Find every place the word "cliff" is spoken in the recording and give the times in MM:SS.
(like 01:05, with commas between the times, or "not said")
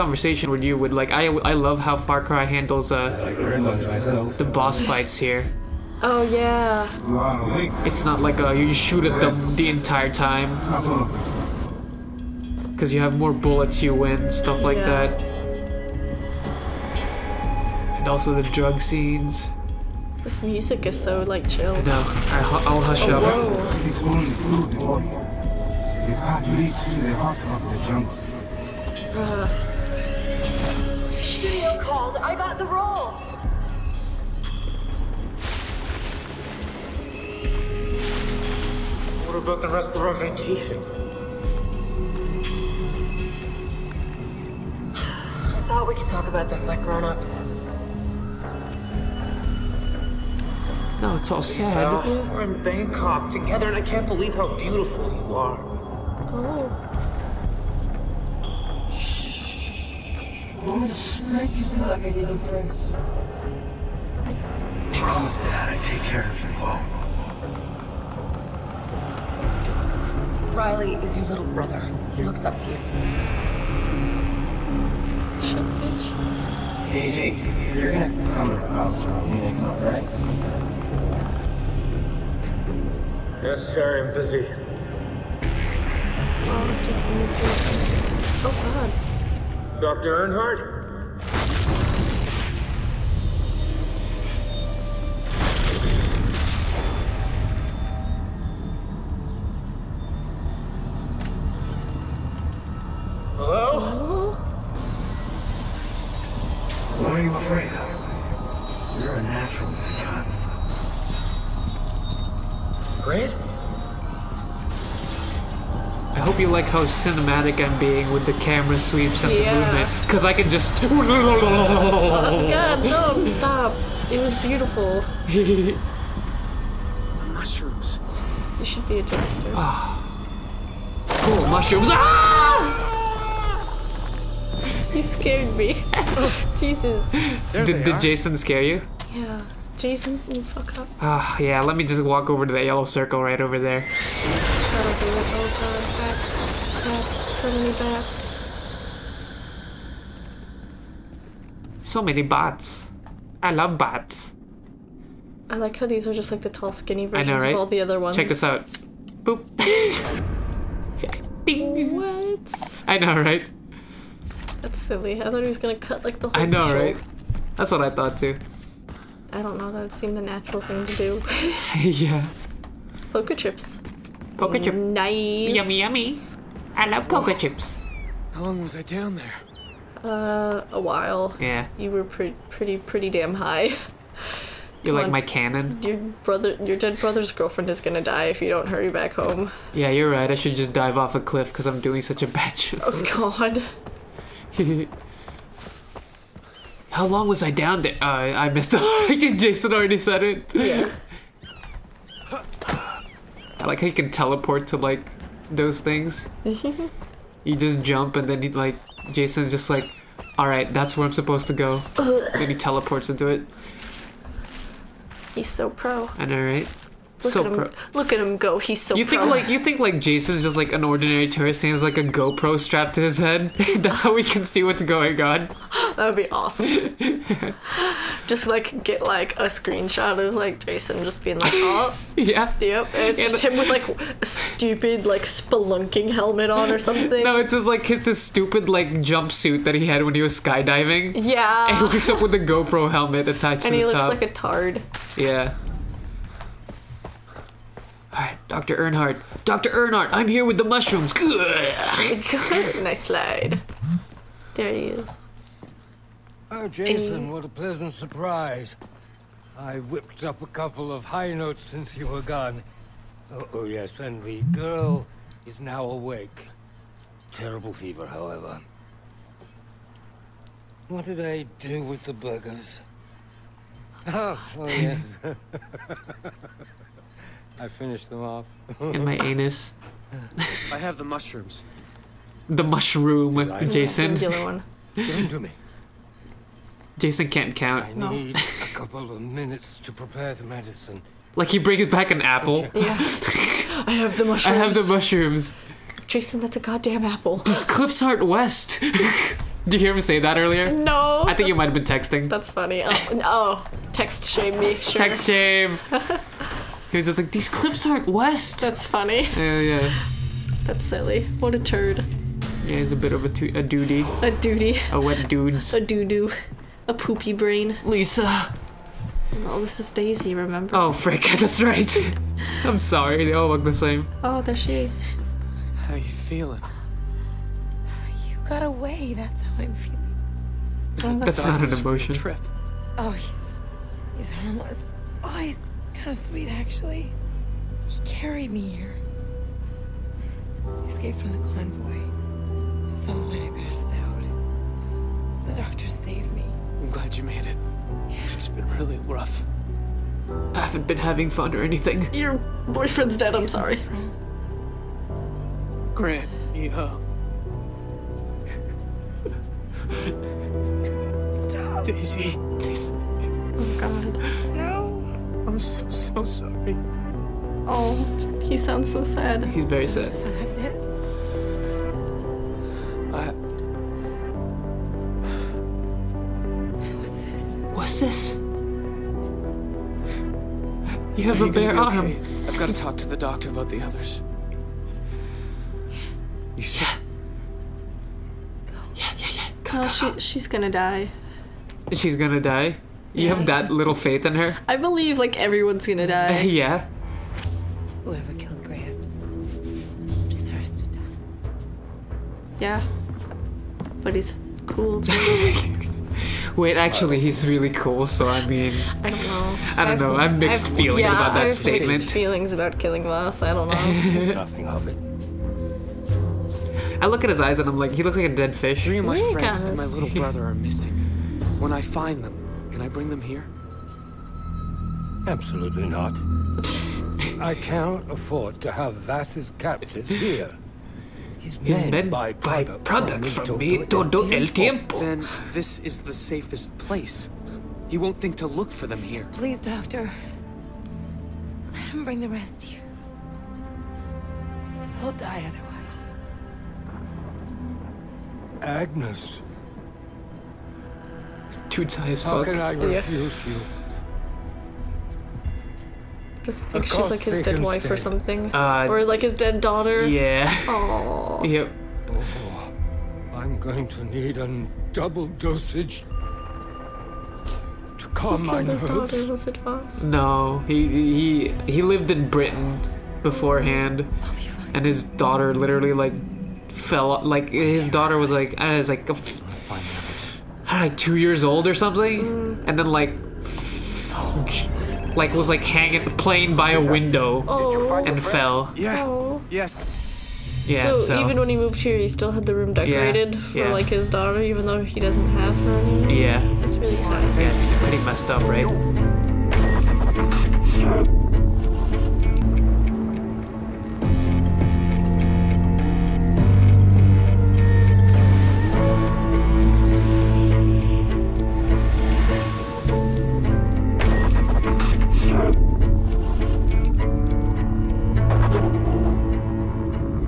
03:11, 04:57, 05:07.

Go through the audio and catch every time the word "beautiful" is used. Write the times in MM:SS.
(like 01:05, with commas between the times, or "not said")
00:54, 02:04.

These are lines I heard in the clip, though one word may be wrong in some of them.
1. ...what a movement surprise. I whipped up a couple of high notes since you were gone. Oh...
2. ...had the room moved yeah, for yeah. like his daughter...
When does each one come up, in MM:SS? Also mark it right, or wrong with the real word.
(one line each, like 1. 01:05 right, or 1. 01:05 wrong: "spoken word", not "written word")
1. 04:17 wrong: "pleasant", not "movement"
2. 08:12 wrong: "decorated", not "moved".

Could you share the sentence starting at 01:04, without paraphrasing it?
Promise that I take care of you both.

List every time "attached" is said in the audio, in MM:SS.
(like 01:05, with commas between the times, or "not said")
04:03.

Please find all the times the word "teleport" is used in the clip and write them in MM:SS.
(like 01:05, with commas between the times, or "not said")
03:24, 03:32.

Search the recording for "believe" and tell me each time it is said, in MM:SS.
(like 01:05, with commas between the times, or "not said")
00:54, 06:34.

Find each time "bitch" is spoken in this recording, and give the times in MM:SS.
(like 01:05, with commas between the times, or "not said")
01:15.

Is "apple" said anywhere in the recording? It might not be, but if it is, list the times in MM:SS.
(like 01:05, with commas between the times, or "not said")
04:52, 04:57.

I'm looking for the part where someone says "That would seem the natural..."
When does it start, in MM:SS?
02:49.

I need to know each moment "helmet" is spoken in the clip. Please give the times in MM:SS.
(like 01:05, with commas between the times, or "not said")
03:56, 04:02.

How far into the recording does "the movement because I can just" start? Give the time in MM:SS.
01:59.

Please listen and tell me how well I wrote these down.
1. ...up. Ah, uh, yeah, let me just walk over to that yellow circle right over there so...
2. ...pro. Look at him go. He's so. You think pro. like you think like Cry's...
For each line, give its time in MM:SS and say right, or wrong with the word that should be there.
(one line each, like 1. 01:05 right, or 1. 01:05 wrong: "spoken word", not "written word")
1. 02:20 right
2. 03:37 wrong: "Jason", not "Cry".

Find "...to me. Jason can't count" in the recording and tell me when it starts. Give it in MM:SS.
04:45.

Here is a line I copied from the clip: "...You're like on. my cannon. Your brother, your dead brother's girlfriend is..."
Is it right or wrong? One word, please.
right.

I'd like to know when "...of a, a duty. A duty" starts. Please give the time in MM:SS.
05:13.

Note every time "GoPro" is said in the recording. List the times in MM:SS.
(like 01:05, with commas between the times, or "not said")
03:42, 04:02.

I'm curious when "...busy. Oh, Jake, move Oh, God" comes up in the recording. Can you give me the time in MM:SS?
01:24.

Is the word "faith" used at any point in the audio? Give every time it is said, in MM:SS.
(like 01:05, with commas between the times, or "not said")
06:33.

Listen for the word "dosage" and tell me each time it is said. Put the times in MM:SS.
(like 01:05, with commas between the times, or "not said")
07:45.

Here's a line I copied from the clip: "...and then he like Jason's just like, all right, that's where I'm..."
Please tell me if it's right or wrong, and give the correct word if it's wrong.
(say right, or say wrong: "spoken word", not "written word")
right.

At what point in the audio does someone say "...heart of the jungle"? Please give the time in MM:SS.
00:27.